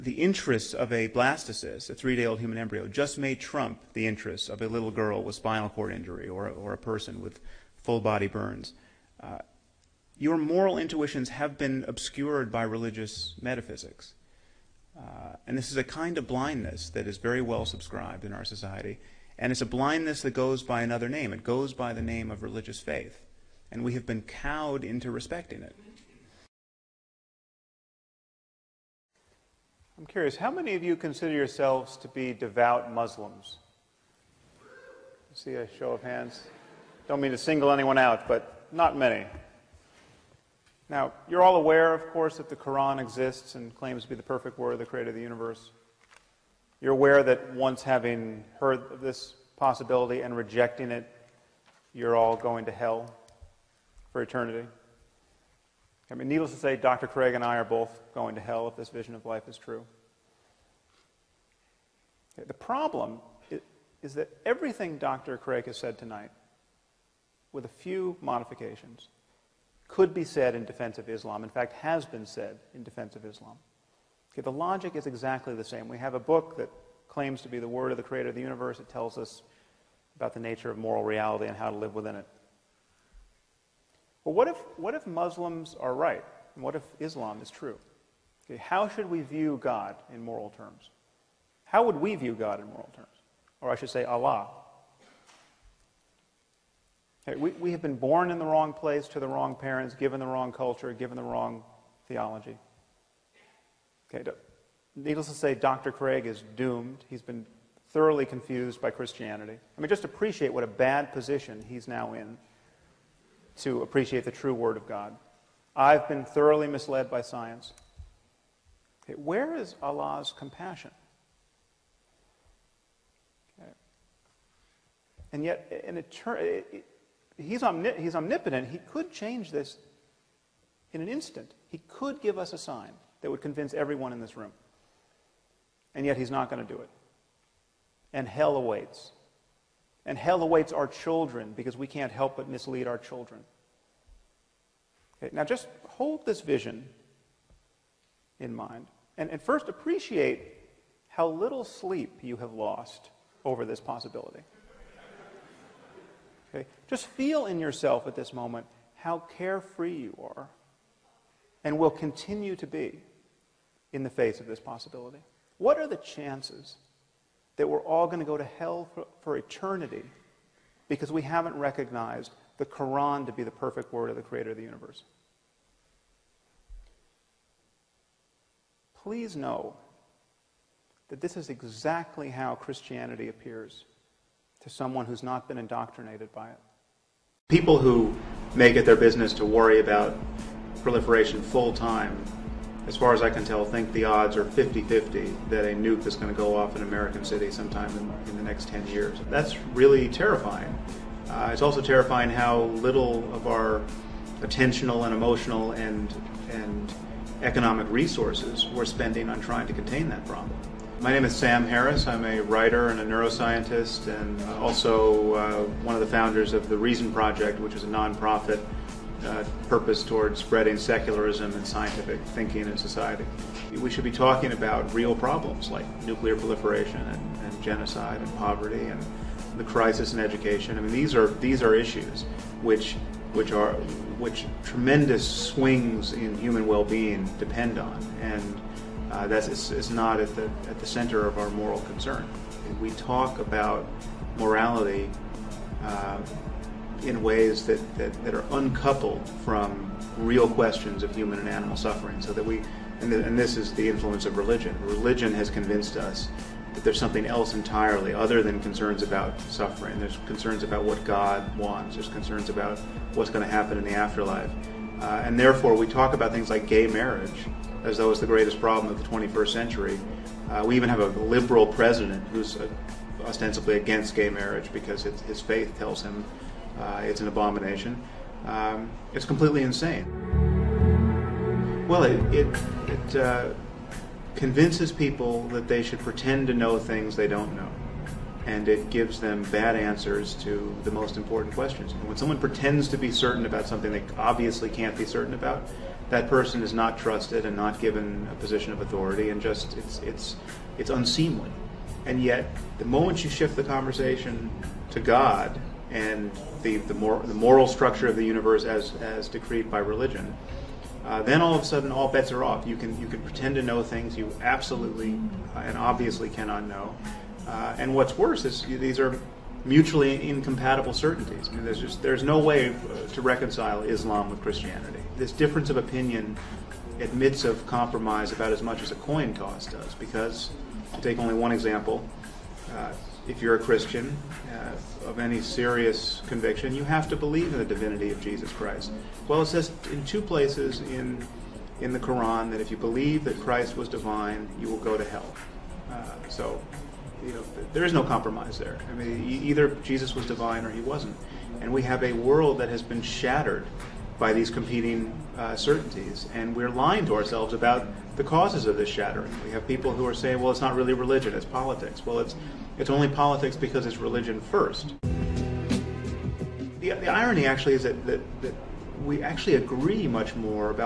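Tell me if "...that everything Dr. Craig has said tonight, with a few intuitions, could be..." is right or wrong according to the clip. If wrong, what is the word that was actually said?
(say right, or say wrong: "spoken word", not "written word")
wrong: "modifications", not "intuitions".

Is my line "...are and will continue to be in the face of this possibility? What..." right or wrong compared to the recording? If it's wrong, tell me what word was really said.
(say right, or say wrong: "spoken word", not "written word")
right.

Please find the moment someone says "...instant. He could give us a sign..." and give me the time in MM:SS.
02:11.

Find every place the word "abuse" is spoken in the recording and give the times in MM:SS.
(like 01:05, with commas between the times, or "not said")
not said.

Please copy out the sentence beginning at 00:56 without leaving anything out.
I mean, needless to say, Dr.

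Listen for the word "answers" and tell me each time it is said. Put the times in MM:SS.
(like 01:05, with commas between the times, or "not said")
04:49.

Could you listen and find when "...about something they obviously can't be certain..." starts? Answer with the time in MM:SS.
04:53.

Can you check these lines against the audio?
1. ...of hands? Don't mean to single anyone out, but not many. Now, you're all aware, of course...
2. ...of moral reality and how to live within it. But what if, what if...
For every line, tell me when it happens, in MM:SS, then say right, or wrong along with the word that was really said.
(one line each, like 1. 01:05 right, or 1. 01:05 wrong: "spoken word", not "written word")
1. 00:35 right
2. 01:20 right.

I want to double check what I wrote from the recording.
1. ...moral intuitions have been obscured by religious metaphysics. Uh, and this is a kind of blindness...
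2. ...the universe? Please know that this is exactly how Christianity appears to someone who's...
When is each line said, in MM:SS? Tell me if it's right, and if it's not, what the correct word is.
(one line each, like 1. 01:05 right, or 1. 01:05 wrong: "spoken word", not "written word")
1. 00:10 right
2. 02:54 right.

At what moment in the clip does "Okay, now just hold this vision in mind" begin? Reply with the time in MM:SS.
02:25.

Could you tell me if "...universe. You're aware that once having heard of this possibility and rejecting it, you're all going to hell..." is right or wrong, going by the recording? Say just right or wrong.
right.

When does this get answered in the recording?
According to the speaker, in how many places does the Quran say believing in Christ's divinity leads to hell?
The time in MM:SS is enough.
05:40.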